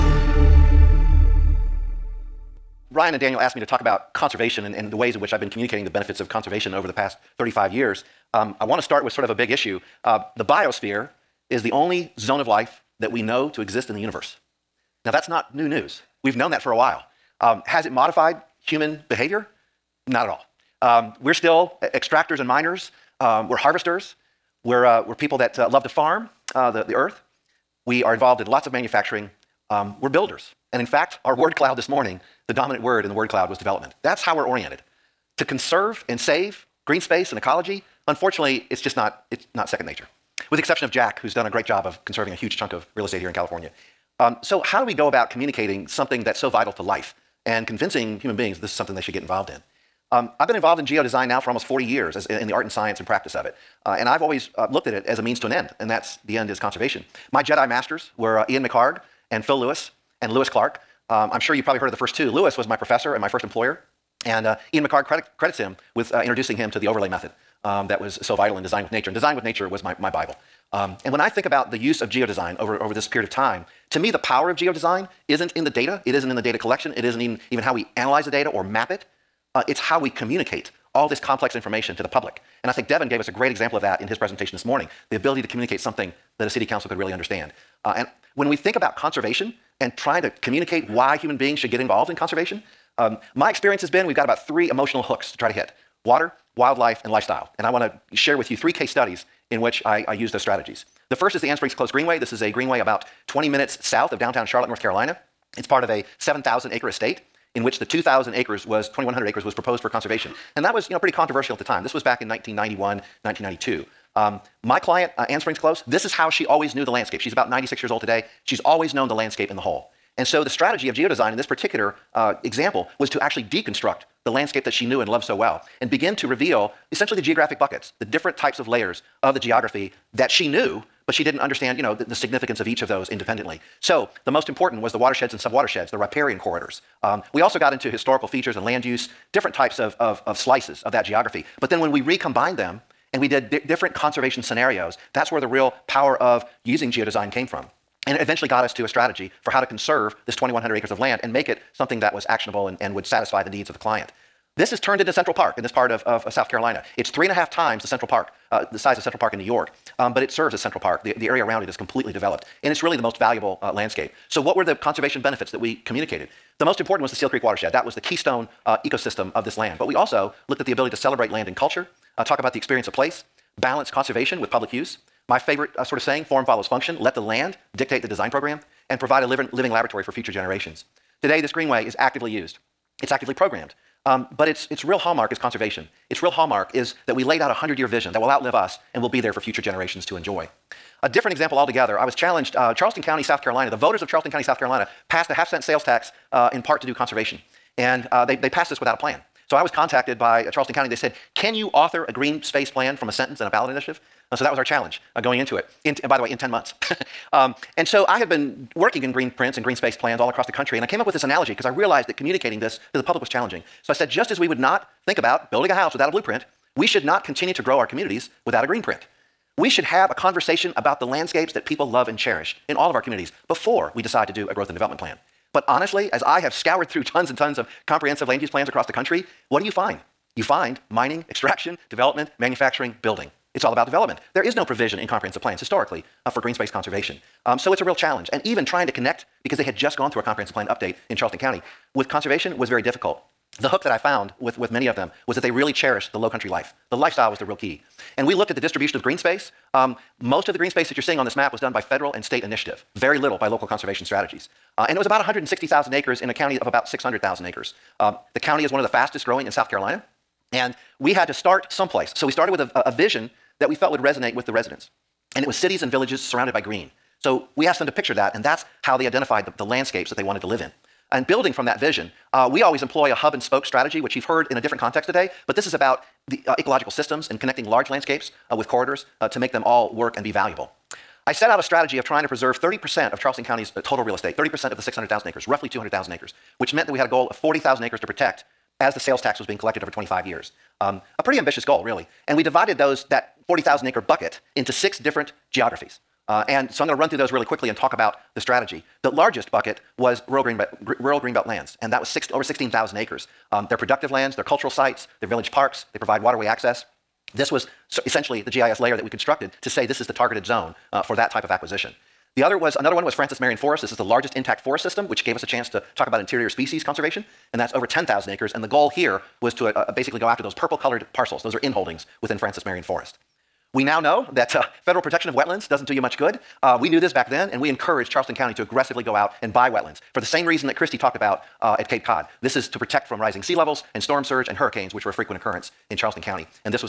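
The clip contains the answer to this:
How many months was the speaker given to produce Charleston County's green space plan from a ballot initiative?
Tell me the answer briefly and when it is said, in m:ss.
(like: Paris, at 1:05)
10, at 3:26.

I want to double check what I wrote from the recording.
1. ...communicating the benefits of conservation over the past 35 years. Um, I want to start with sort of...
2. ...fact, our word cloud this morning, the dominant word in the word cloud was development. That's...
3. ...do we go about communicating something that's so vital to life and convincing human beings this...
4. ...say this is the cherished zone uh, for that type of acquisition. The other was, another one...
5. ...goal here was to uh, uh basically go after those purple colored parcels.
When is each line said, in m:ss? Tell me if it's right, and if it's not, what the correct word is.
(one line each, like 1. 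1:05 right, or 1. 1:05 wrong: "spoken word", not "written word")
1. 0:05 right
2. 0:30 right
3. 0:44 right
4. 5:09 wrong: "targeted", not "cherished"
5. 5:18 right.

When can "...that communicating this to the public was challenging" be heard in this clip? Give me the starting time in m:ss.
3:32.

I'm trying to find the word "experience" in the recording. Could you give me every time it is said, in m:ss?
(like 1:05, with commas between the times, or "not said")
1:33, 2:52.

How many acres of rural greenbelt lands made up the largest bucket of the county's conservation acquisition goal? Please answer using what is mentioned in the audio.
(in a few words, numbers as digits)
over 16,000 acres.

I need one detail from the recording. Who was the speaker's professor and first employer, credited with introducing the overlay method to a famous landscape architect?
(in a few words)
Lewis Clarke.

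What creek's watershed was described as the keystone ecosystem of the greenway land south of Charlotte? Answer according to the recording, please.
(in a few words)
Steele Creek.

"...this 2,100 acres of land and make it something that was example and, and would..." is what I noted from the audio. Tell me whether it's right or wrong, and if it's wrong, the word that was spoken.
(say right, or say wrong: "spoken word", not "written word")
wrong: "actionable", not "example".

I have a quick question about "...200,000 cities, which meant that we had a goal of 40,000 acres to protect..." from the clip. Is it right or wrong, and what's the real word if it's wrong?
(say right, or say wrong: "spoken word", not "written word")
wrong: "acres", not "cities".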